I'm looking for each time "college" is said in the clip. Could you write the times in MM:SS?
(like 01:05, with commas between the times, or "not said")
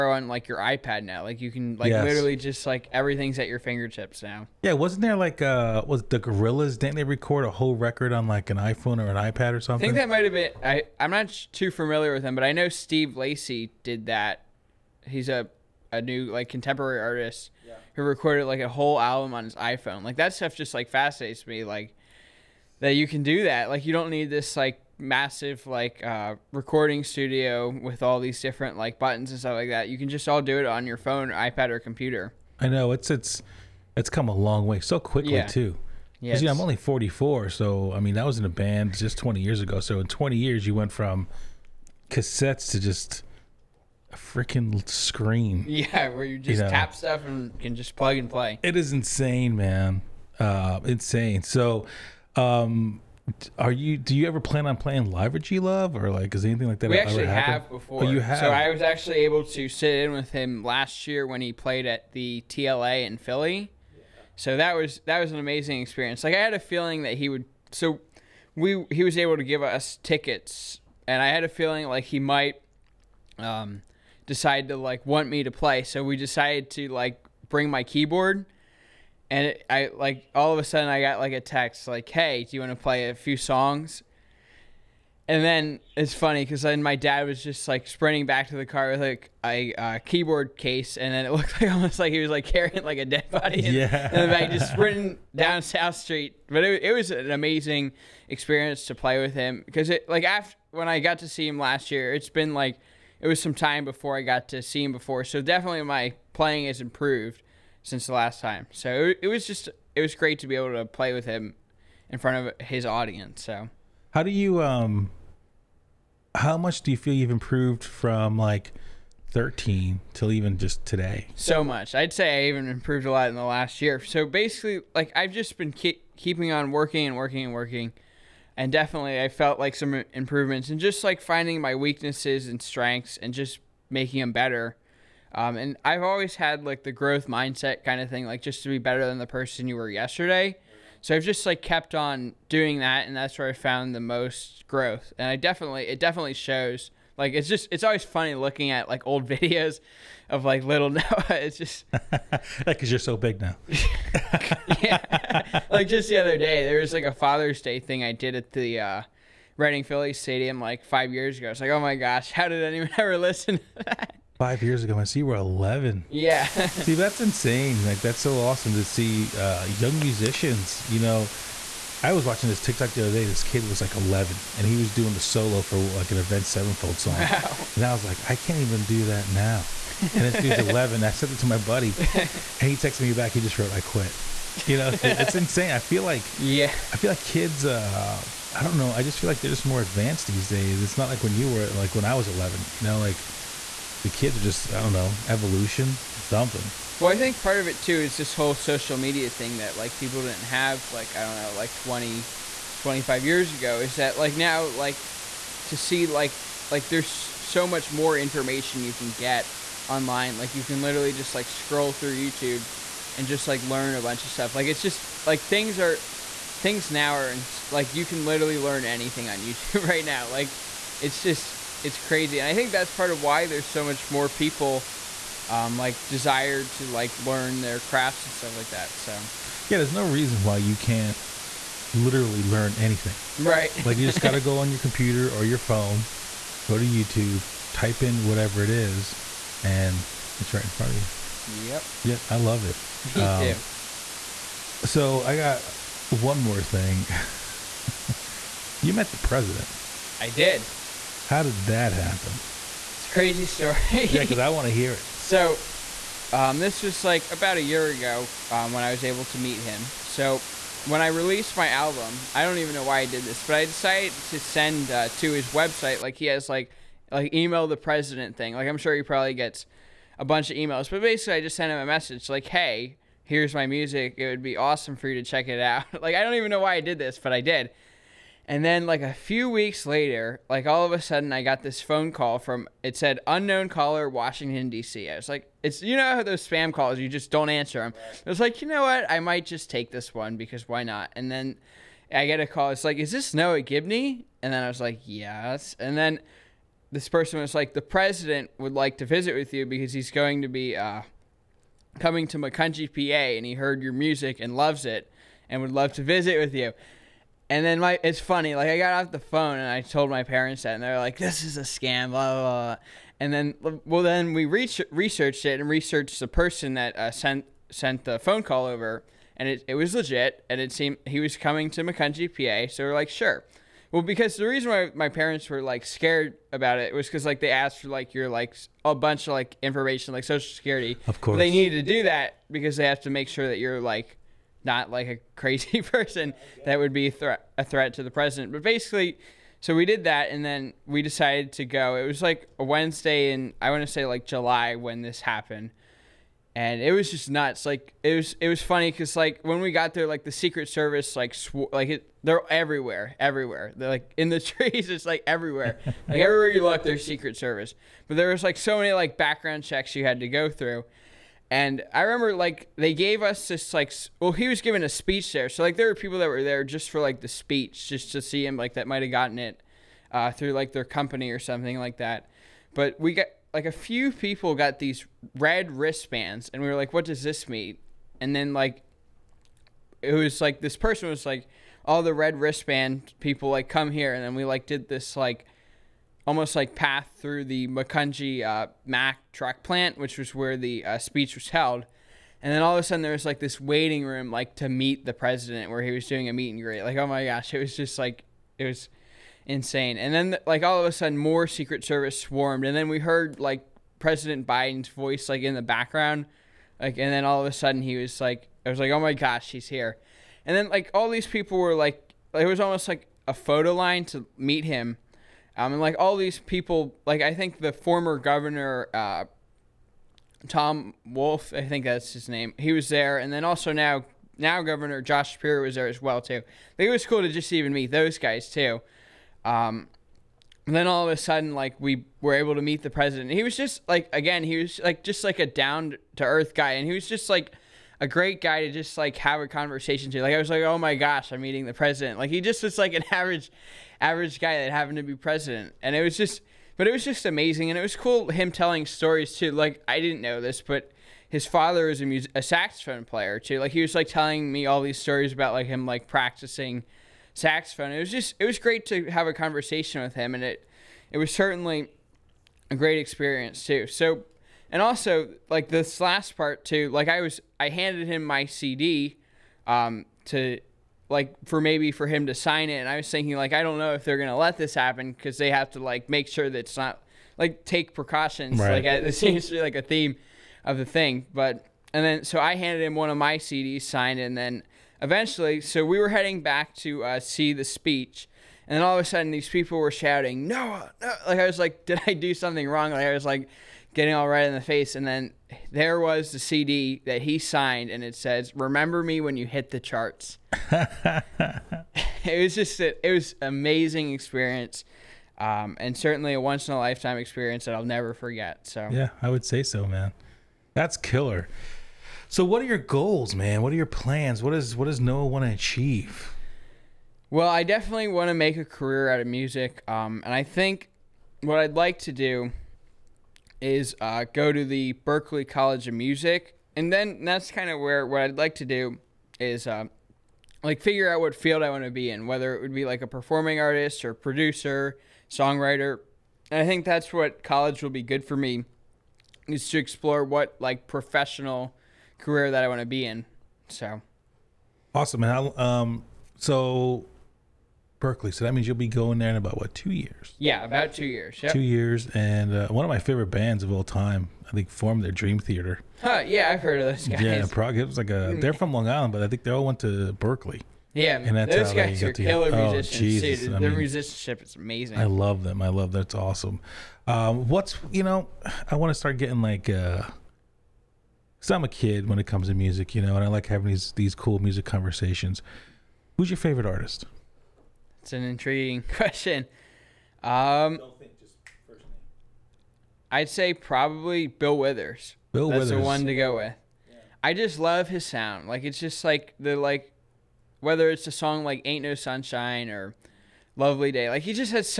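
08:45, 08:57.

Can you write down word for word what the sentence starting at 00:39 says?
So in 20 years, you went from cassettes to just a freaking screen.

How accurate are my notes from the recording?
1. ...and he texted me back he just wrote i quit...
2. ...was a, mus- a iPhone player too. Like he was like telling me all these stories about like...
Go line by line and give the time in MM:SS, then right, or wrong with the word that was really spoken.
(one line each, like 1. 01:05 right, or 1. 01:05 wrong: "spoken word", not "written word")
1. 03:01 right
2. 07:31 wrong: "saxophone", not "iPhone".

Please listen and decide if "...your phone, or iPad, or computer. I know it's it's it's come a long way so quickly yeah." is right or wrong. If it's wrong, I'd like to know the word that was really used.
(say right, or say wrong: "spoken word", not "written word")
right.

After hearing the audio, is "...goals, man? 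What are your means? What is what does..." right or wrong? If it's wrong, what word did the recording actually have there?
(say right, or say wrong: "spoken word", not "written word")
wrong: "plans", not "means".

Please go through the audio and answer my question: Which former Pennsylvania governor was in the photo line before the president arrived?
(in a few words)
Tom Wolf.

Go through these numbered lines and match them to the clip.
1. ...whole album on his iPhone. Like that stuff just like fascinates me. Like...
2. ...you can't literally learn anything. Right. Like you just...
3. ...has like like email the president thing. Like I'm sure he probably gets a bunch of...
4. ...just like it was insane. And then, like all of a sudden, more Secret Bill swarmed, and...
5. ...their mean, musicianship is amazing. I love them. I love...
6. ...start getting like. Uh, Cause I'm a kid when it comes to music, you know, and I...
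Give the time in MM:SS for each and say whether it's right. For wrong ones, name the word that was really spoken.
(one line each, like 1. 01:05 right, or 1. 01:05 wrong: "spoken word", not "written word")
1. 00:18 right
2. 03:50 right
3. 04:26 right
4. 06:37 wrong: "Service", not "Bill"
5. 09:23 right
6. 09:28 right.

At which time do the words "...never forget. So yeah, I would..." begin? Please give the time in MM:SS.
08:27.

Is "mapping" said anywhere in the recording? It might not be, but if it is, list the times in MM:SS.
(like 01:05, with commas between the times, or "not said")
not said.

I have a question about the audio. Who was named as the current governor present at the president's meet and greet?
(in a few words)
Josh Shapiro.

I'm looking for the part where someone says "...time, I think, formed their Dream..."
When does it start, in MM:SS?
09:13.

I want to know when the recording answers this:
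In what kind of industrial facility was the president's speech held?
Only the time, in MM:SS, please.
06:28.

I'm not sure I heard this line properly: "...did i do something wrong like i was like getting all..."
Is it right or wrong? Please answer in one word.
right.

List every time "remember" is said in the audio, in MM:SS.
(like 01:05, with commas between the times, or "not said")
06:02, 08:18.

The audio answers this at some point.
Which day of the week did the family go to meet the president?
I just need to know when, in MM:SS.
05:42.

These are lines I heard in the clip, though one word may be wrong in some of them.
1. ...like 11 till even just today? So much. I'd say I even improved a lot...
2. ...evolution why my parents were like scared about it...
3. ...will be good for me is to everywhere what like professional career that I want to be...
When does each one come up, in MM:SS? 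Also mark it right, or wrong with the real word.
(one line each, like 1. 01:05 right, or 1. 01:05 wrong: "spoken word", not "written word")
1. 01:58 wrong: "13", not "11"
2. 05:24 wrong: "reason", not "evolution"
3. 08:57 wrong: "explore", not "everywhere".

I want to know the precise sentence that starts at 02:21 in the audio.
So I've just like kept on doing that, and that's where I found the most growth.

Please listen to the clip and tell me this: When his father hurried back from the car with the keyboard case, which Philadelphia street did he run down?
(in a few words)
South Street.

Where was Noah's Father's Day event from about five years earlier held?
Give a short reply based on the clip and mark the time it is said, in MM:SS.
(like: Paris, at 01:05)
Reading Philly Stadium, at 02:39.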